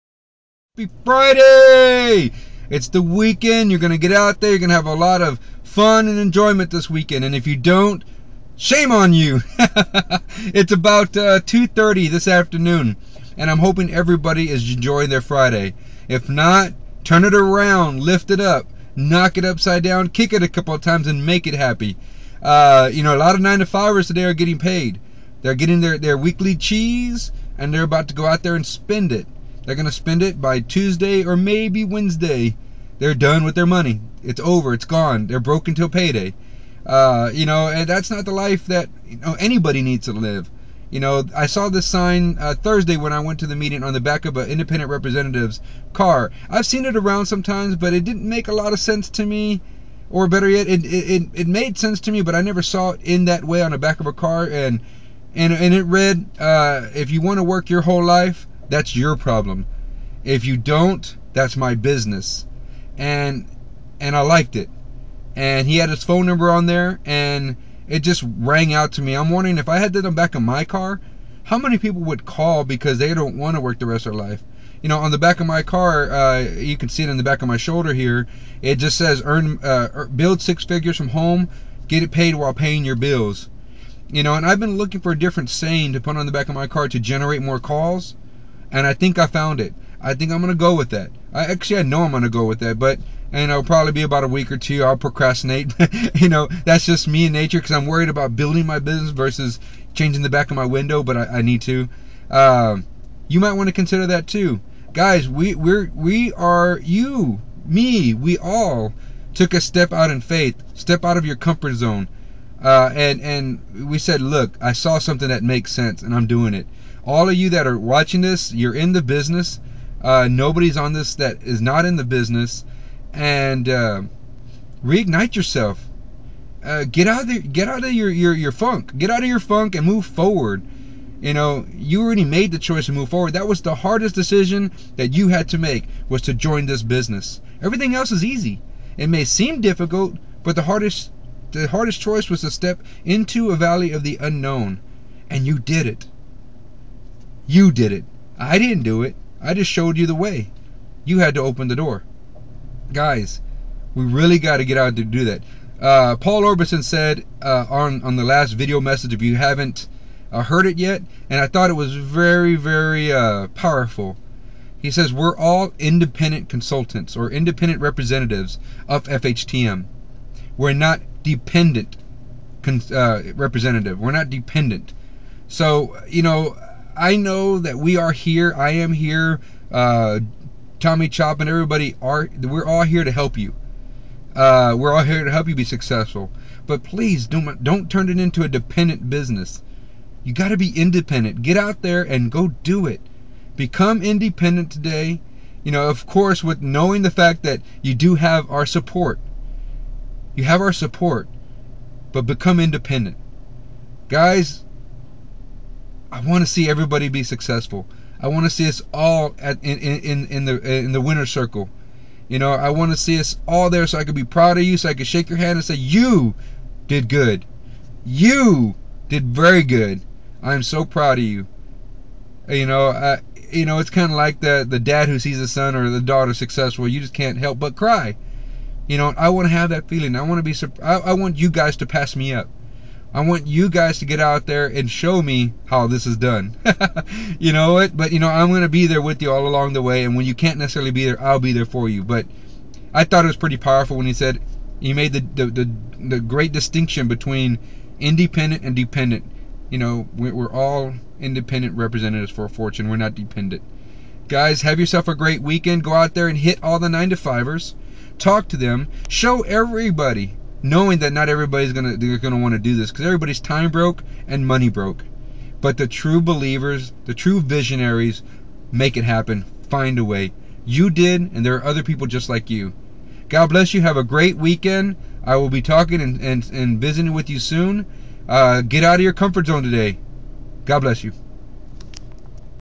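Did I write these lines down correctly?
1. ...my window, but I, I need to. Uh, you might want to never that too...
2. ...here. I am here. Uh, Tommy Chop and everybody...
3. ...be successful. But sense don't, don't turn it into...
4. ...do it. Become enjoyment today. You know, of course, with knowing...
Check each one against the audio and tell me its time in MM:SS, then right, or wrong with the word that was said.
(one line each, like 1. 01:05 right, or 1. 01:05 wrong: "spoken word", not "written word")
1. 01:40 wrong: "consider", not "never"
2. 02:58 right
3. 03:05 wrong: "please", not "sense"
4. 03:12 wrong: "independent", not "enjoyment".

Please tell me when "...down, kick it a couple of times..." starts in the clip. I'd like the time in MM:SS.
00:19.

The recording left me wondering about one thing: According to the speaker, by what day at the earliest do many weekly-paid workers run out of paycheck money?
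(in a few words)
Tuesday.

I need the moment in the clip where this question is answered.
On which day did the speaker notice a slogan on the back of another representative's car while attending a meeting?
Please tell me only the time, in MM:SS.
00:42.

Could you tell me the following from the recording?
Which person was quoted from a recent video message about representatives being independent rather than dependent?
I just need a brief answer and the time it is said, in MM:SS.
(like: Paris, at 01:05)
Paul Orbison, at 02:36.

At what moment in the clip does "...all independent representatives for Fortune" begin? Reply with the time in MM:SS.
04:10.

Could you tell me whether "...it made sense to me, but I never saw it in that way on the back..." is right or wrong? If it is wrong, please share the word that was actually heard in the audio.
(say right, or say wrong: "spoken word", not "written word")
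right.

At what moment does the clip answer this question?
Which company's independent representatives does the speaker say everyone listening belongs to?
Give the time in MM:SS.
02:49.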